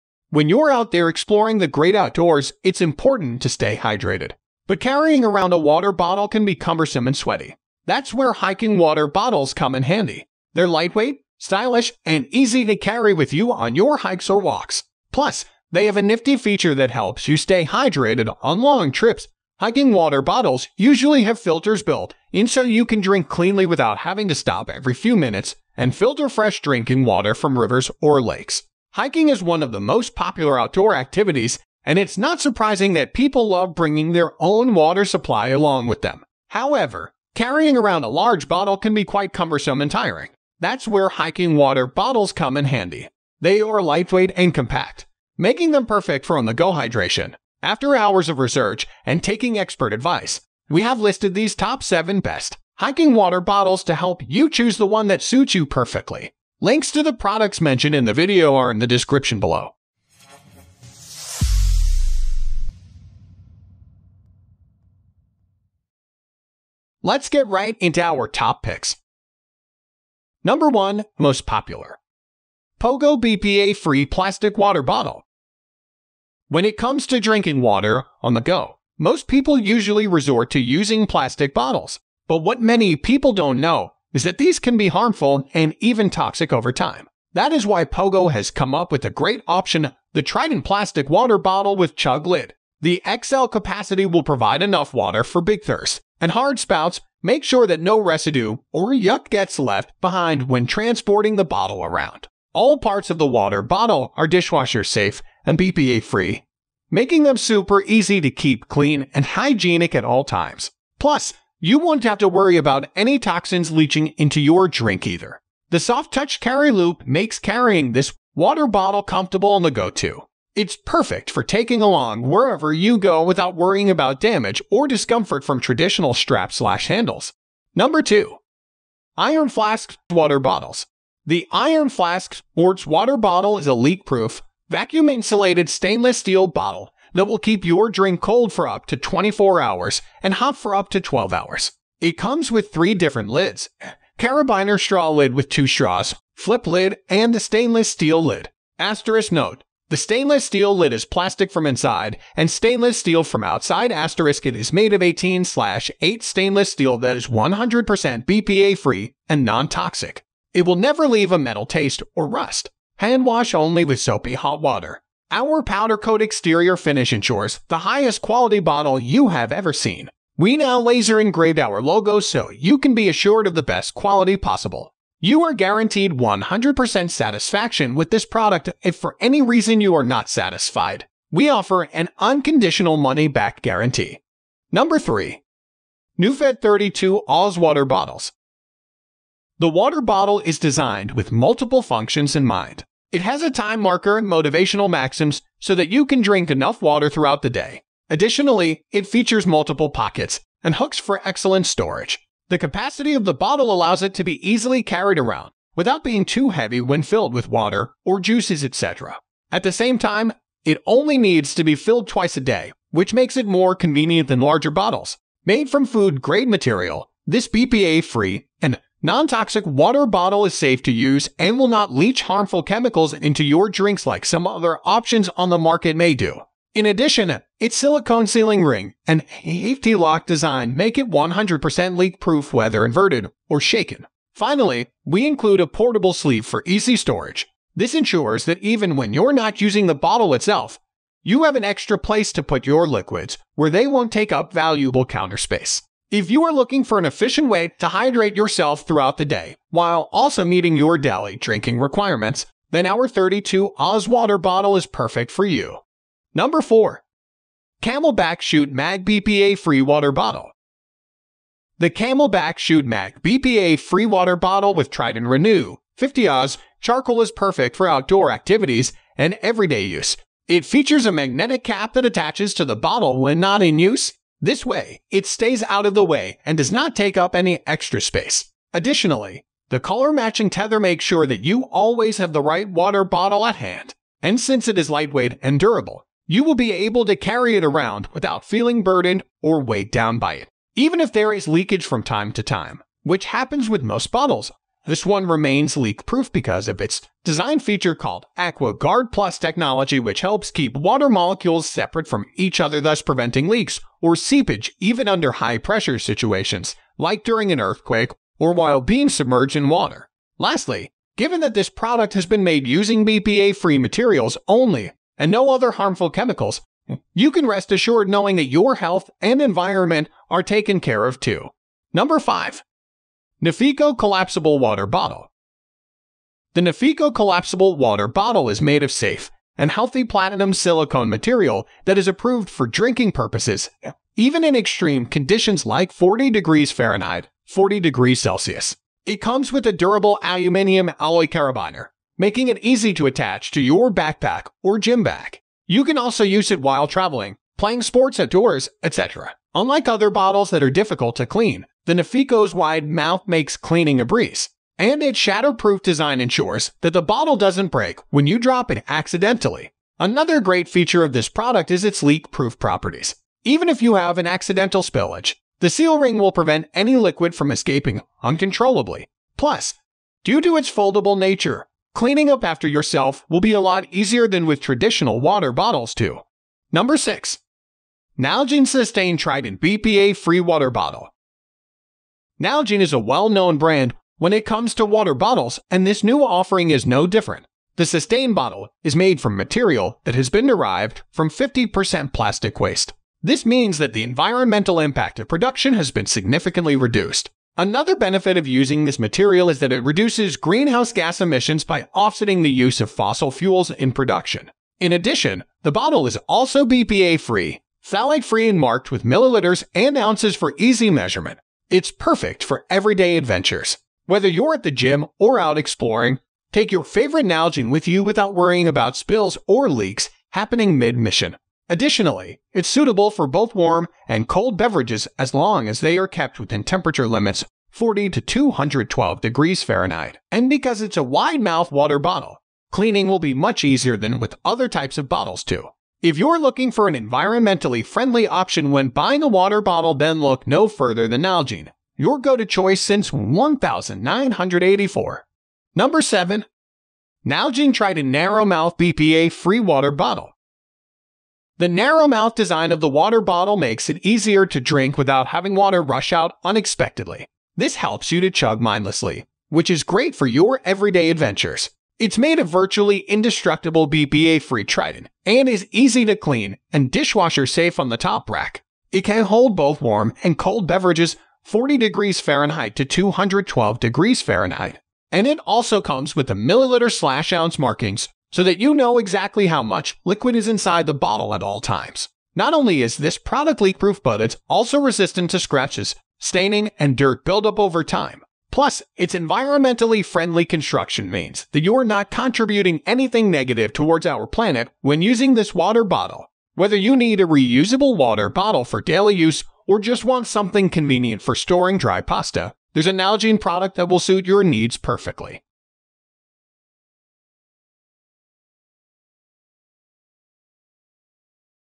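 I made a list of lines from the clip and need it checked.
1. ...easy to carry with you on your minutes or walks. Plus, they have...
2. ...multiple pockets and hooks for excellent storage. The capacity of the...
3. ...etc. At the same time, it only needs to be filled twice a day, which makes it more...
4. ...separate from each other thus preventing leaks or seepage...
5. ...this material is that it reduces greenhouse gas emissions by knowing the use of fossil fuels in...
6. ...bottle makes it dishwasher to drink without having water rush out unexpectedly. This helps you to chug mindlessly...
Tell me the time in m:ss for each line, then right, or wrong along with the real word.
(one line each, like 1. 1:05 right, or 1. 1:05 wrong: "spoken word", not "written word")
1. 0:12 wrong: "hikes", not "minutes"
2. 3:19 right
3. 3:28 right
4. 5:01 right
5. 6:38 wrong: "offsetting", not "knowing"
6. 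7:33 wrong: "easier", not "dishwasher".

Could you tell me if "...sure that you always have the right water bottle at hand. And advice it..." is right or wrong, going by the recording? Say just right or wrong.
wrong.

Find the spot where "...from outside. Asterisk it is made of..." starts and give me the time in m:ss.
2:33.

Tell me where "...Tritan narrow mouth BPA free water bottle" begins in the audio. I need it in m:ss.
7:27.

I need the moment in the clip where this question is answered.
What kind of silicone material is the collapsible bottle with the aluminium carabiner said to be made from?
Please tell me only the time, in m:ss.
5:30.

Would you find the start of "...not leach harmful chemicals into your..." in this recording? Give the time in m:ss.
3:41.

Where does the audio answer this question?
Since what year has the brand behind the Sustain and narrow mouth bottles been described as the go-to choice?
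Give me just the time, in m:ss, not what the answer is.
7:23.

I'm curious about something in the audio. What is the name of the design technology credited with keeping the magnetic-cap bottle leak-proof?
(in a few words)
AquaGuard Plus.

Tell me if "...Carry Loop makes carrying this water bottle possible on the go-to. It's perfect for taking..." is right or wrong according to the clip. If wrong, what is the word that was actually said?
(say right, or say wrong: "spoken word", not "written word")
wrong: "comfortable", not "possible".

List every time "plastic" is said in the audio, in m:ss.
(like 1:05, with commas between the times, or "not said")
1:14, 1:21, 1:30, 2:31, 6:32.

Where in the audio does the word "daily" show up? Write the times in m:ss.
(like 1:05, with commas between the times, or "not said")
4:10, 8:18.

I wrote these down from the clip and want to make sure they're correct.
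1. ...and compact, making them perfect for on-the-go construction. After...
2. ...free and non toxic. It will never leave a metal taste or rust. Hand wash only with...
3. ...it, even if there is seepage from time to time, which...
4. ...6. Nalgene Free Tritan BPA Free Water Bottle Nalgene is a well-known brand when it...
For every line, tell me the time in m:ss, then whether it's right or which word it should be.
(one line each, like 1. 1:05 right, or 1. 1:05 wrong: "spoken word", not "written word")
1. 0:44 wrong: "hydration", not "construction"
2. 2:38 right
3. 4:50 wrong: "leakage", not "seepage"
4. 6:16 wrong: "Sustain", not "Free".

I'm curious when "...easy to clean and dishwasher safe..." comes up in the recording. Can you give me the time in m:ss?
7:45.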